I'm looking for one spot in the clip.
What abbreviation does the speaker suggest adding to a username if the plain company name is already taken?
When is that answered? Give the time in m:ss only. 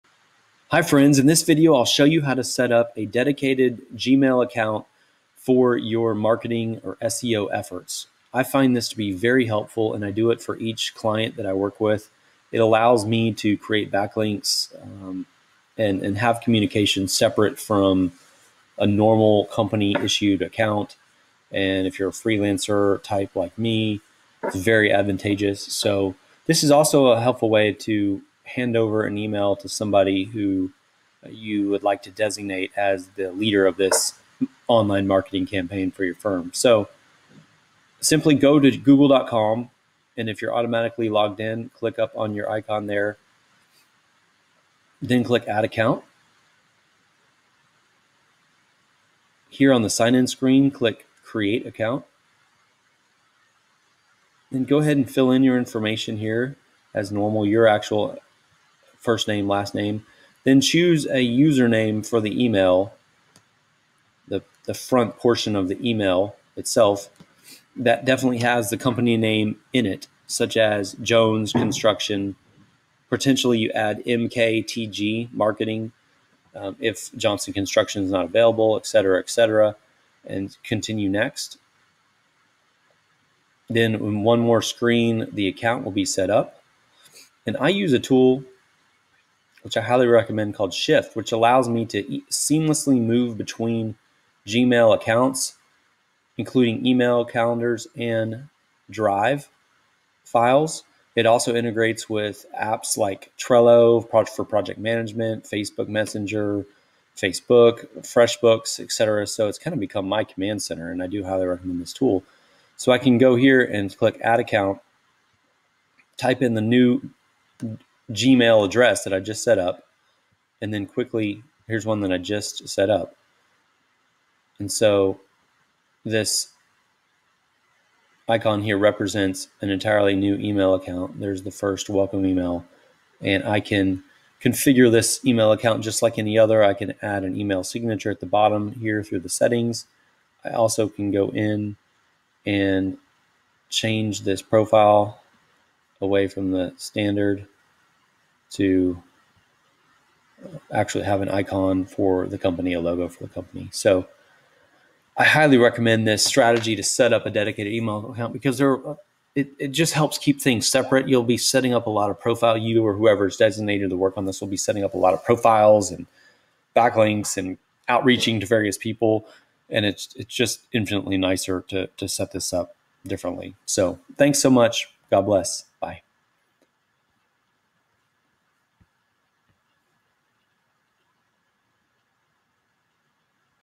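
1:14.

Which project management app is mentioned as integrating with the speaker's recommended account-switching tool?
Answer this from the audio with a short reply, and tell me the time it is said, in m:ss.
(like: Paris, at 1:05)
Trello, at 1:43.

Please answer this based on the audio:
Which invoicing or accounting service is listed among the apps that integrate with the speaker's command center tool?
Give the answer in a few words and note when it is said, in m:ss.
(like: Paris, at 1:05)
FreshBooks, at 1:48.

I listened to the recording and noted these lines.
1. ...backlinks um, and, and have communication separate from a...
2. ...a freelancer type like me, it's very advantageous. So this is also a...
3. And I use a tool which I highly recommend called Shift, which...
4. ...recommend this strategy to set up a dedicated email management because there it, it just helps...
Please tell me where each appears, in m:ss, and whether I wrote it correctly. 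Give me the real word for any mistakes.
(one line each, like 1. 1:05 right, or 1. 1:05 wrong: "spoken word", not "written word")
1. 0:13 right
2. 0:22 right
3. 1:27 right
4. 2:35 wrong: "account", not "management".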